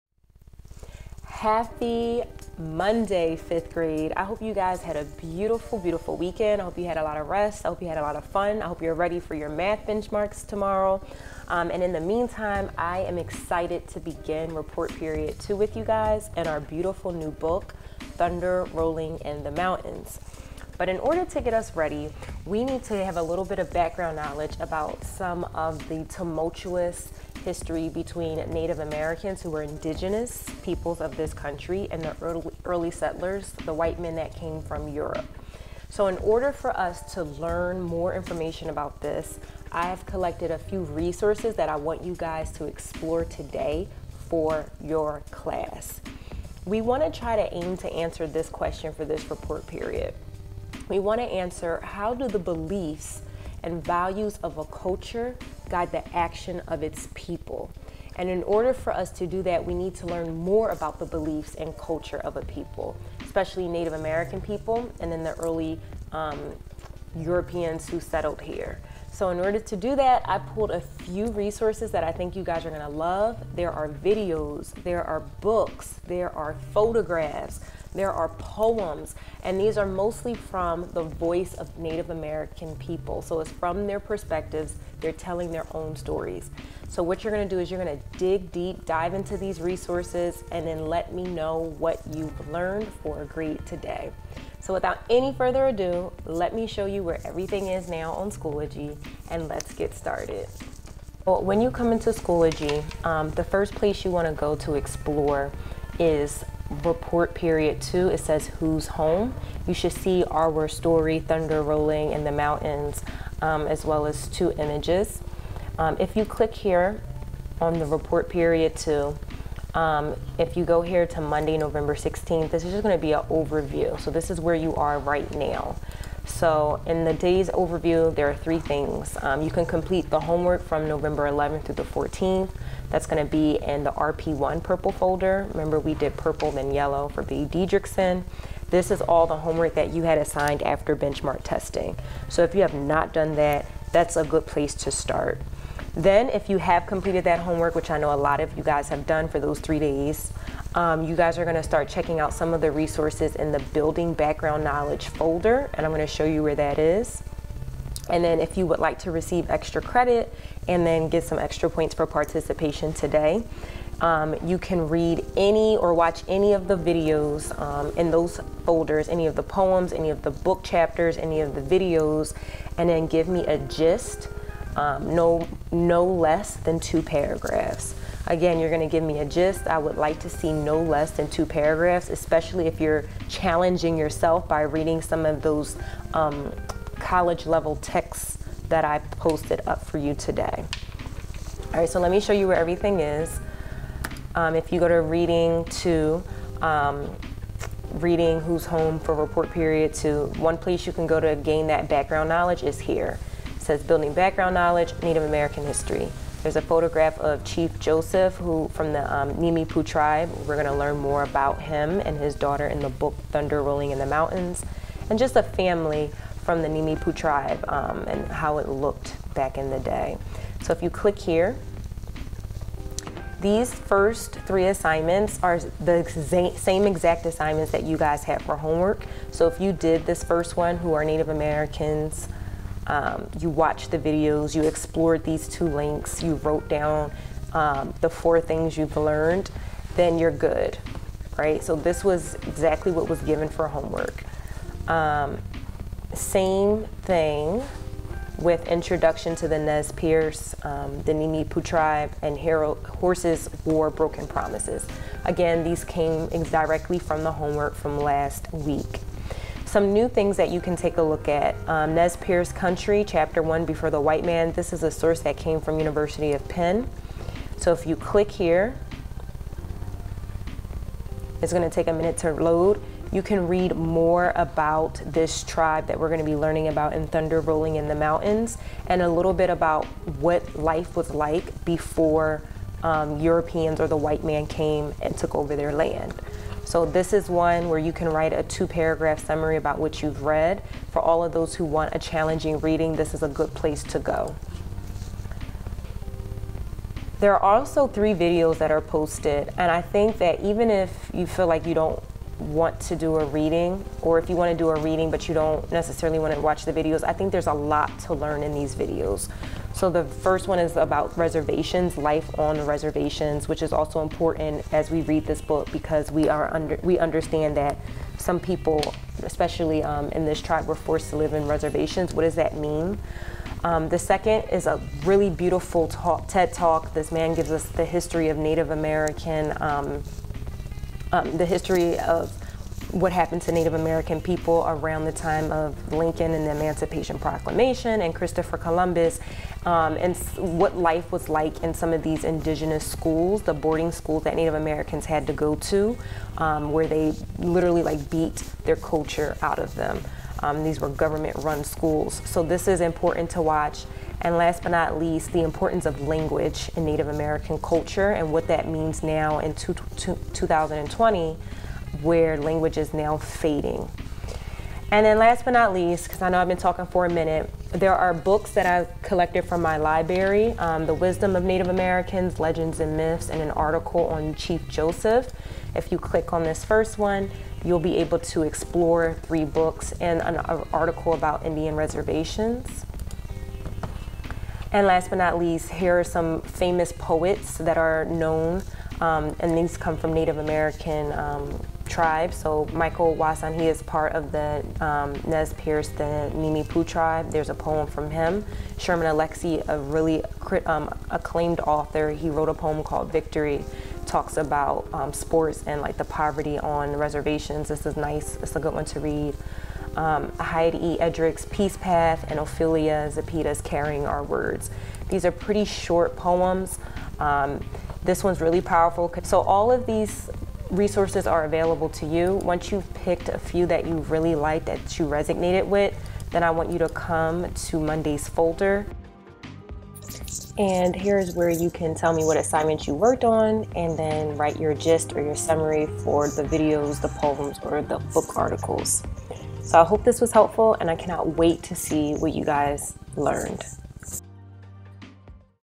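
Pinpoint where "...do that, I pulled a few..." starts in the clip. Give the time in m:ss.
1:09.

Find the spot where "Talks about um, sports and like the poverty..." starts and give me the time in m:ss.
6:44.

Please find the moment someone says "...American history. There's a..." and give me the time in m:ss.
3:25.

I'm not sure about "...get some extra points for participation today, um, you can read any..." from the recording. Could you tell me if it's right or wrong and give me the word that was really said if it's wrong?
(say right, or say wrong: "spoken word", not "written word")
right.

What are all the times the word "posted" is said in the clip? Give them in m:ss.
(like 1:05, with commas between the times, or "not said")
3:08, 4:58.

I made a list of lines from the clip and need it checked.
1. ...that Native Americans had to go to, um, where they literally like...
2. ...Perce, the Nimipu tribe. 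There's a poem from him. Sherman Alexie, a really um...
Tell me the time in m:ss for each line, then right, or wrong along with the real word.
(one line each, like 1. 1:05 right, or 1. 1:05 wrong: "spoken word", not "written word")
1. 5:44 right
2. 6:35 right.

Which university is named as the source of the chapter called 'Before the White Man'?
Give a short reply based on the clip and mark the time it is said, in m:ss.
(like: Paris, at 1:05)
University of Penn, at 4:25.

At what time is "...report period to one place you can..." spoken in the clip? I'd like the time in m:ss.
3:19.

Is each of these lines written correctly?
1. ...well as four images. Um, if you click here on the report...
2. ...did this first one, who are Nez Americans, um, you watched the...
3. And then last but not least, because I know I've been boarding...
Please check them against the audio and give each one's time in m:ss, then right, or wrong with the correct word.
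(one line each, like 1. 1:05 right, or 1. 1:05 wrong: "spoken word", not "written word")
1. 1:53 wrong: "two", not "four"
2. 3:49 wrong: "Native", not "Nez"
3. 6:04 wrong: "talking", not "boarding".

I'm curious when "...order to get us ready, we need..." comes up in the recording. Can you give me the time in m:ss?
0:20.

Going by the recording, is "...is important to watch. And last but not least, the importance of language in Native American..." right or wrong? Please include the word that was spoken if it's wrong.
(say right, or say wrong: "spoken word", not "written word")
right.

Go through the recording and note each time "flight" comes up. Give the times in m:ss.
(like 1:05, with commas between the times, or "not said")
not said.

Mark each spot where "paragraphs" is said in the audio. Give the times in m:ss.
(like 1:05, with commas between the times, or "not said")
2:57, 3:01, 4:48.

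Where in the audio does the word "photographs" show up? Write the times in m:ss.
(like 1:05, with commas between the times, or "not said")
1:16, 3:26.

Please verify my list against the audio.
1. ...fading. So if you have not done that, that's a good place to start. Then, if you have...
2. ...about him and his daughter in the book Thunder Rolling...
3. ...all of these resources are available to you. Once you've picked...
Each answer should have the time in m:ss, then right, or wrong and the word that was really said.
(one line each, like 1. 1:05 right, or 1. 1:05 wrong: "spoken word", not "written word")
1. 2:21 wrong: "testing", not "fading"
2. 3:31 right
3. 6:59 right.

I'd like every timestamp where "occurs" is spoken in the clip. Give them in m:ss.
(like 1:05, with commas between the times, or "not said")
not said.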